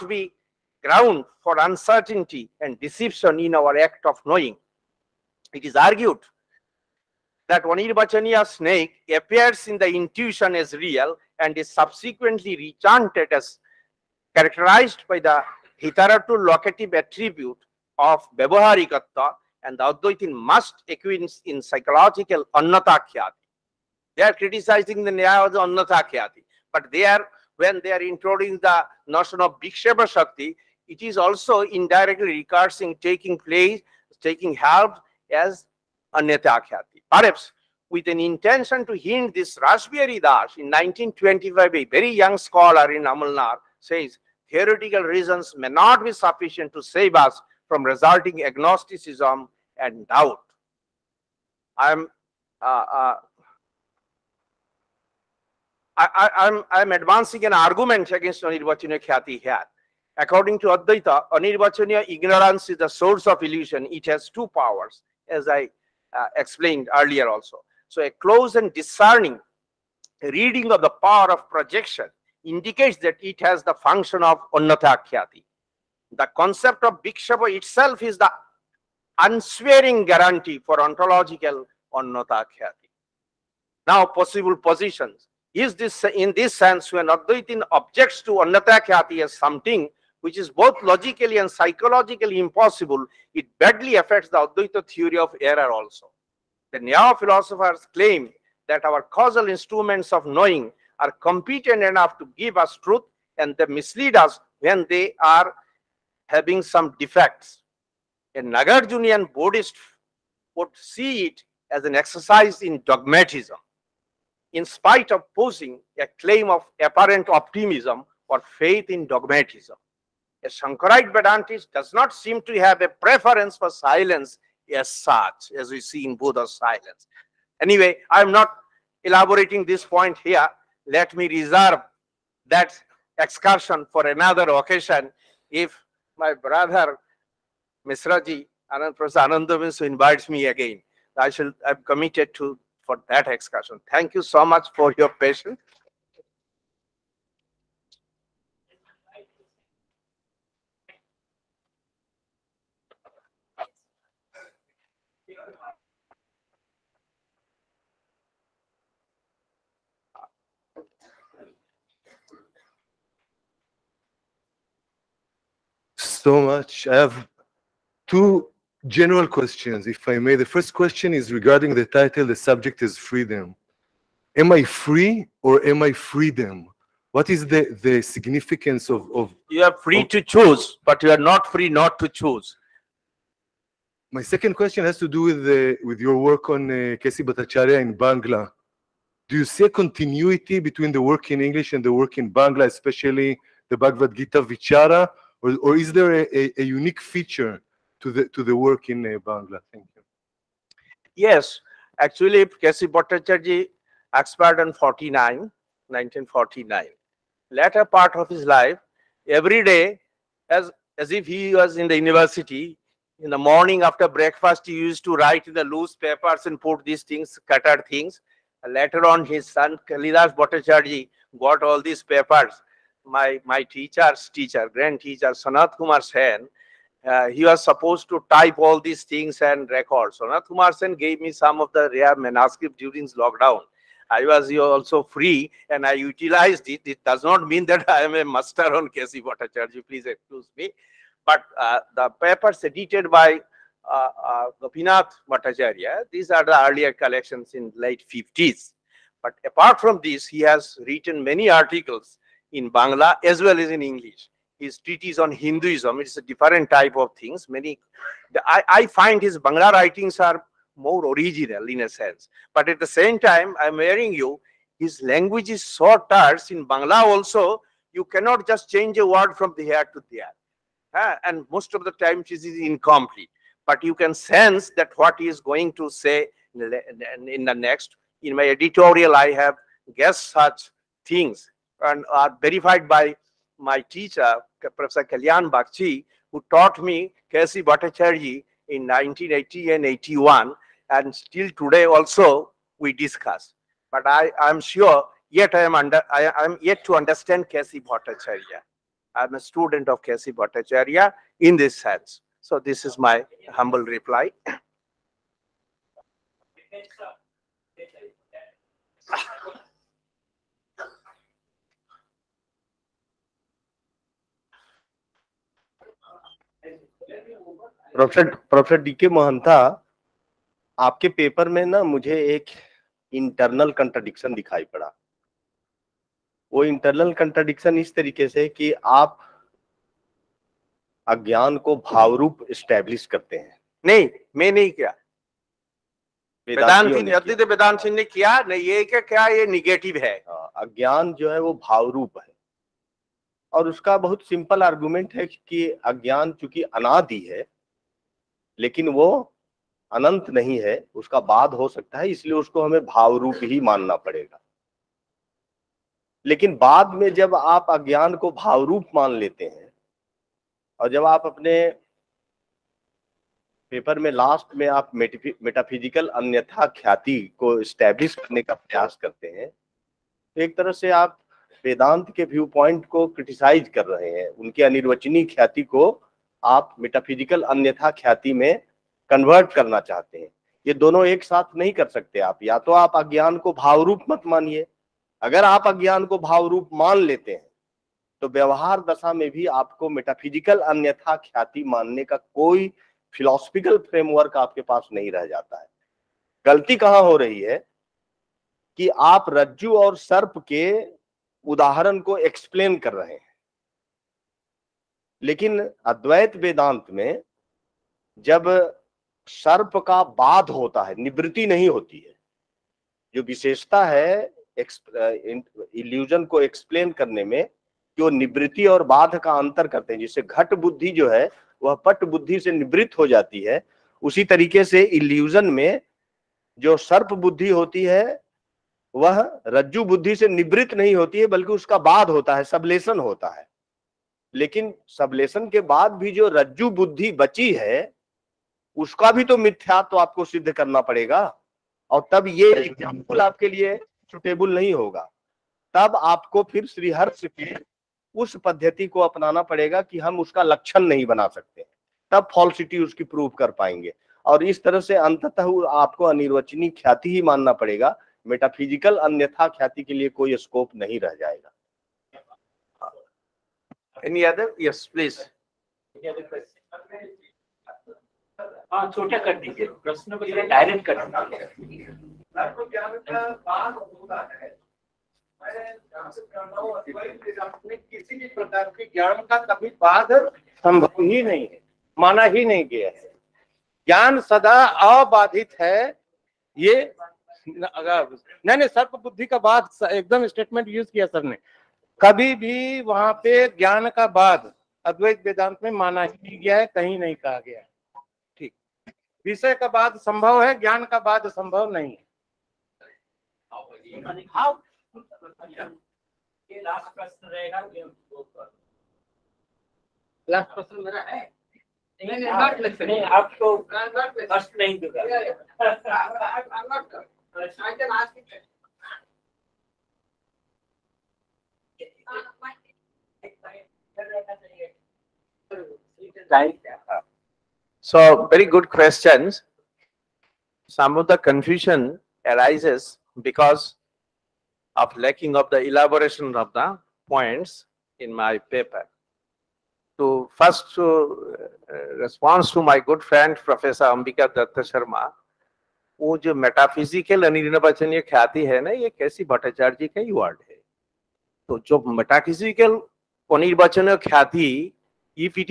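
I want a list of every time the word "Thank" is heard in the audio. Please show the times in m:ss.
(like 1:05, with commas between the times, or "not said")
2:23, 3:19.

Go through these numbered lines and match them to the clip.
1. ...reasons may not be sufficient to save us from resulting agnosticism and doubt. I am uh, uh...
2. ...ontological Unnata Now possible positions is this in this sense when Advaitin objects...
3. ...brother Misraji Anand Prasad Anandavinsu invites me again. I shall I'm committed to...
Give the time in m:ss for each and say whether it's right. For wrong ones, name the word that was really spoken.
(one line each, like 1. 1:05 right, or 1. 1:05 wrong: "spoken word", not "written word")
1. 0:45 right
2. 1:20 right
3. 2:16 right.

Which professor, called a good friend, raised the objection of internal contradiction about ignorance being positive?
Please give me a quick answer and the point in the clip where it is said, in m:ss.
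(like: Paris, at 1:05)
Ambika Datta Sharma, at 9:03.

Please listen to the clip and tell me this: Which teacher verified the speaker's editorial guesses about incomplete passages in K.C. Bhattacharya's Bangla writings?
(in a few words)
Kalyan Bagchi.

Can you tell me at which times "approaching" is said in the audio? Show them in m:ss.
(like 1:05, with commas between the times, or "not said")
not said.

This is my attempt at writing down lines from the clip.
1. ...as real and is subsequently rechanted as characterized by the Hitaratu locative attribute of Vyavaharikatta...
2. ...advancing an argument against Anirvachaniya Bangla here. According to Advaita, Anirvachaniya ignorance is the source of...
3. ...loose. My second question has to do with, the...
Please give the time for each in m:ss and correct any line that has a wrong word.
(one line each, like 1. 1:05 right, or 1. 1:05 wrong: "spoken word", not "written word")
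1. 0:10 right
2. 0:56 wrong: "Khyati", not "Bangla"
3. 3:02 wrong: "choose", not "loose".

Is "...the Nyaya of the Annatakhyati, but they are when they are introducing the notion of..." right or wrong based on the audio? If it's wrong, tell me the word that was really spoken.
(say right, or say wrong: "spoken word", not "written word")
right.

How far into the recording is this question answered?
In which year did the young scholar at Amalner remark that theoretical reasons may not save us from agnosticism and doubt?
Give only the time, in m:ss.
0:40.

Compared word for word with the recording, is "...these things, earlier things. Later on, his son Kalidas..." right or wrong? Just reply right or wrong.
wrong.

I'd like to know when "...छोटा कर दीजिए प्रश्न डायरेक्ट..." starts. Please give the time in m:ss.
7:48.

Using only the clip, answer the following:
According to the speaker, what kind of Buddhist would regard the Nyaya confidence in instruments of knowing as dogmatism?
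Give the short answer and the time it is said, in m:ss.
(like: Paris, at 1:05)
Nagarjunian, at 1:48.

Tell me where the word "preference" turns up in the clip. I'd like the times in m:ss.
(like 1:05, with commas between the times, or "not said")
2:02.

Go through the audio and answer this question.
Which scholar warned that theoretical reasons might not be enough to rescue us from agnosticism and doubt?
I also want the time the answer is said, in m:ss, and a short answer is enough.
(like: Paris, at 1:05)
Rashbihari Das, at 0:39.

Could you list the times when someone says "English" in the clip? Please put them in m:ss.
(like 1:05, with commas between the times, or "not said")
3:11, 4:13.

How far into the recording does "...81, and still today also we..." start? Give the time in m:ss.
4:49.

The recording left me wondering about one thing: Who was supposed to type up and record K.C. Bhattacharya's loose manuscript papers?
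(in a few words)
Sanat Kumar Sen.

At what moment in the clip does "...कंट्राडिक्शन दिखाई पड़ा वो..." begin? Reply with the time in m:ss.
5:23.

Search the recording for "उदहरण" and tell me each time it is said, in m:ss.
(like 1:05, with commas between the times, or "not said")
6:41.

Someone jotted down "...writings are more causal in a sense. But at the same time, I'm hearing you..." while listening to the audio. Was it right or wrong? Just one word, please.
wrong.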